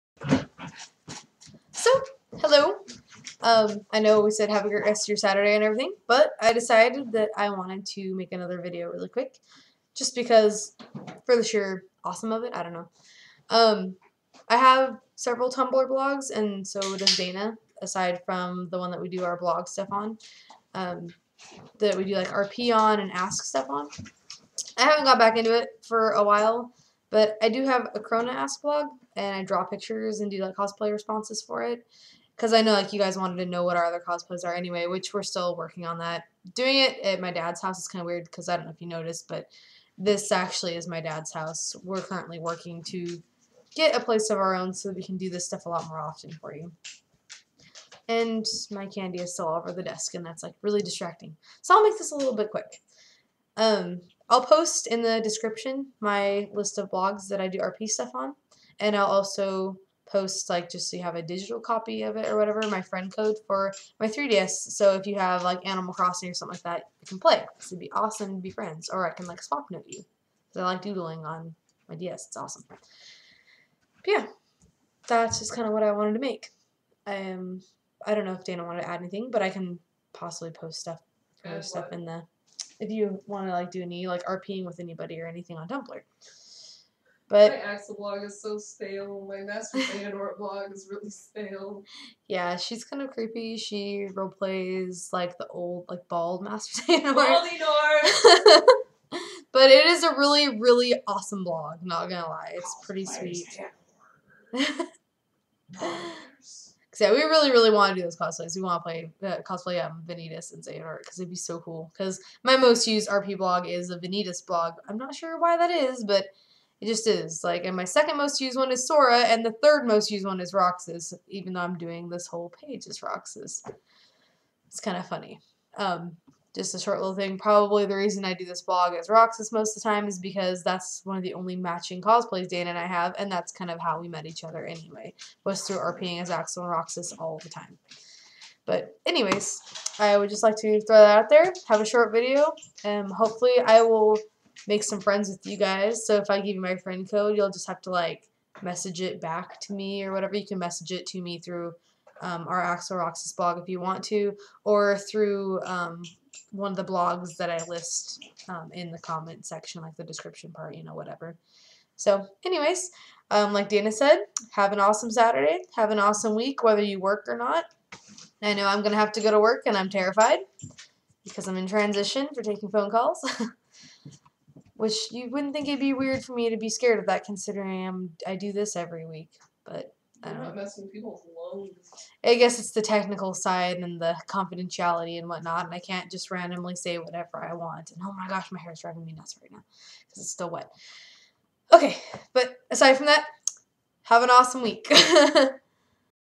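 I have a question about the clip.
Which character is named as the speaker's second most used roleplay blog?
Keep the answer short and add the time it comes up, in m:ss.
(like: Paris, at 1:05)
Sora, at 1:58.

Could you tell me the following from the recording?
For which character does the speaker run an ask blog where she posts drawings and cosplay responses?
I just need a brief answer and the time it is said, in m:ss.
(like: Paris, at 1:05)
Crona, at 0:27.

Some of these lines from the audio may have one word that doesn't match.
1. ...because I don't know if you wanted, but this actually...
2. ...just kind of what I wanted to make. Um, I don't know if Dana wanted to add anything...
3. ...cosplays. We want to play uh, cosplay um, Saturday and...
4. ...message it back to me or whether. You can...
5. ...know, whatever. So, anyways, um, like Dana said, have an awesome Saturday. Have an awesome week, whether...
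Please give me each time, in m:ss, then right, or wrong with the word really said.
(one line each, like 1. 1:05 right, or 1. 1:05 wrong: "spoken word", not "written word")
1. 0:38 wrong: "noticed", not "wanted"
2. 1:15 right
3. 1:48 wrong: "Vanitas", not "Saturday"
4. 2:28 wrong: "whatever", not "whether"
5. 2:40 right.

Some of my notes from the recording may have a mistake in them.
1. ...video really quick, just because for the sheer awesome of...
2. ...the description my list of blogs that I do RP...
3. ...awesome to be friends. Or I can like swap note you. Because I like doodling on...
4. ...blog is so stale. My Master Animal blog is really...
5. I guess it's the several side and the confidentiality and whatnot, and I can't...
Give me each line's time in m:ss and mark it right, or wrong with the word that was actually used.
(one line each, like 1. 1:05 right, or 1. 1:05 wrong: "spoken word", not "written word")
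1. 0:08 right
2. 0:55 right
3. 1:07 right
4. 1:27 wrong: "Xehanort", not "Animal"
5. 3:02 wrong: "technical", not "several".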